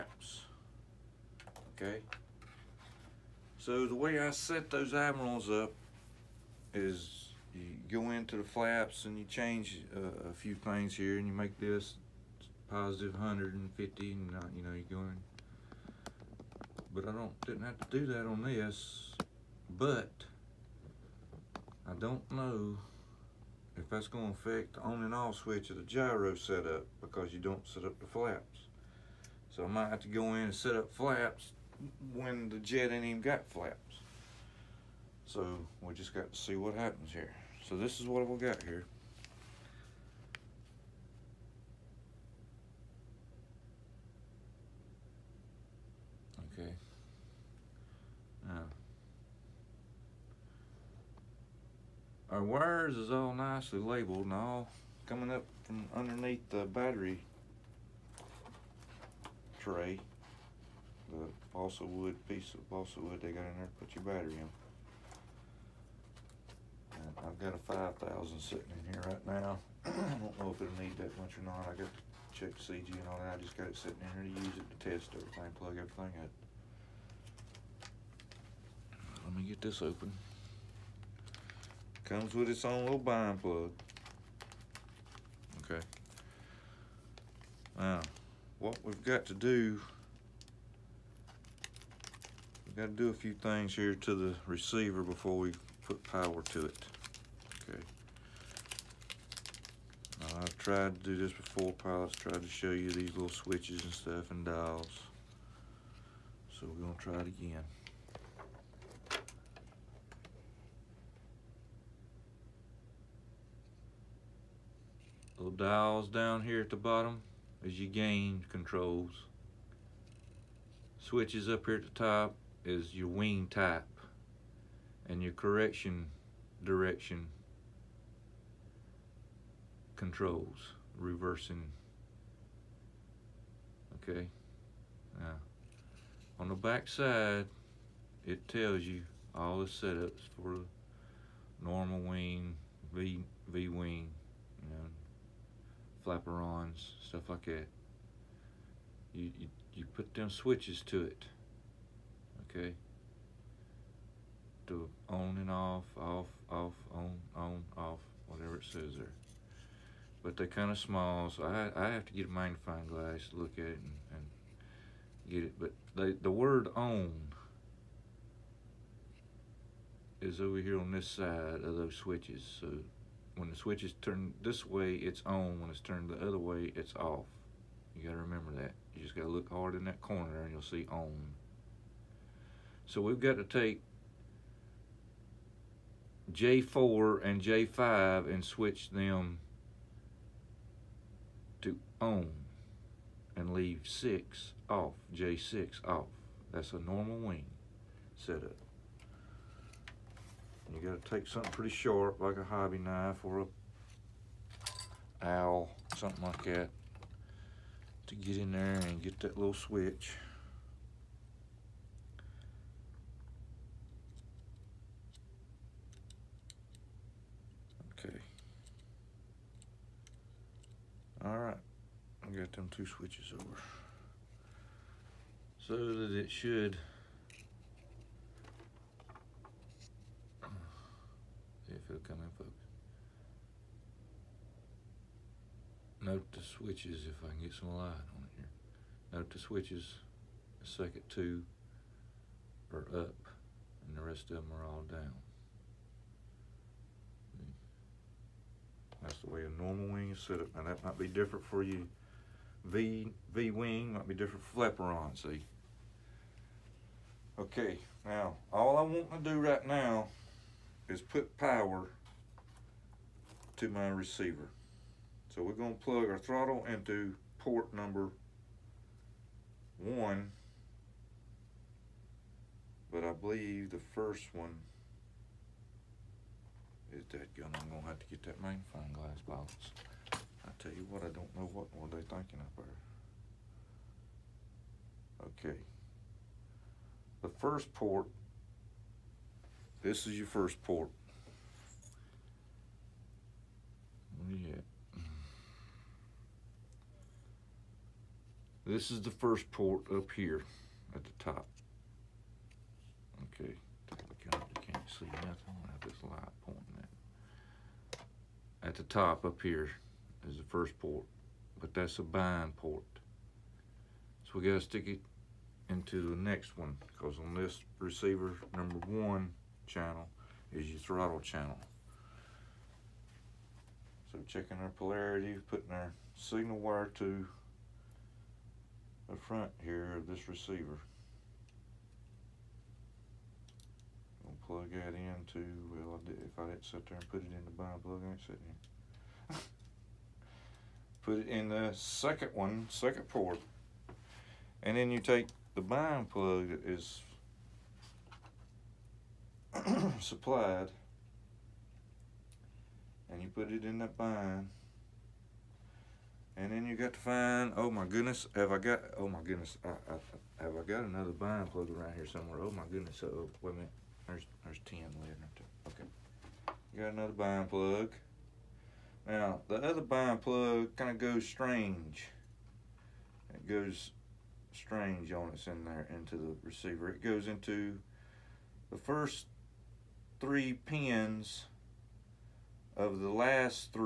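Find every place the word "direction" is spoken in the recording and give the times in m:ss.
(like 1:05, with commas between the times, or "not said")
2:06.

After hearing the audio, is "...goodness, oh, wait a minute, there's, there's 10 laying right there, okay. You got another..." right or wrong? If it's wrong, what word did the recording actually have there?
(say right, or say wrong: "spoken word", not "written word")
right.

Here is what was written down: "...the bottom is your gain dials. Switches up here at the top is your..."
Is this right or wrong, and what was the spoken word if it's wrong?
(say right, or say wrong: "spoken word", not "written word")
wrong: "controls", not "dials".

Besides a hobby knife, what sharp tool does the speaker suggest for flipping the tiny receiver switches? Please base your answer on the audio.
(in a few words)
awl.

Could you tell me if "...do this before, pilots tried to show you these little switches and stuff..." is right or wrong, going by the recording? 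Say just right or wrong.
right.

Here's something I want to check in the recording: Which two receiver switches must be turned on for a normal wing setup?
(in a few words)
J4 and J5.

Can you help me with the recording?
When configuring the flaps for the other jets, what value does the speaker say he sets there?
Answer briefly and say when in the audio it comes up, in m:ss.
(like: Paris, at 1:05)
positive 150, at 0:12.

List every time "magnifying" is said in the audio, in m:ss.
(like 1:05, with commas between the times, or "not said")
2:42, 4:38.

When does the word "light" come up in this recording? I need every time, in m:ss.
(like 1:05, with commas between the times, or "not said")
3:57, 5:06.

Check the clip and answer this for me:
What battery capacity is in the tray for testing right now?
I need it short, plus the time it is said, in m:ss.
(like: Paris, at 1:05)
5,000, at 1:08.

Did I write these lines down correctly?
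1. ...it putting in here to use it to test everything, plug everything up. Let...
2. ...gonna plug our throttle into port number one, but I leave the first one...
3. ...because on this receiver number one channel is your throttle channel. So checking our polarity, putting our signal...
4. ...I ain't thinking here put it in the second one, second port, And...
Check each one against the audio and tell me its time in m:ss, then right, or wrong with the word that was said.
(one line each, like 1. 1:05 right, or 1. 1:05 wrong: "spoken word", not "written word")
1. 1:13 wrong: "sitting", not "putting"
2. 4:25 wrong: "believe", not "leave"
3. 5:16 right
4. 5:38 wrong: "sitting", not "thinking".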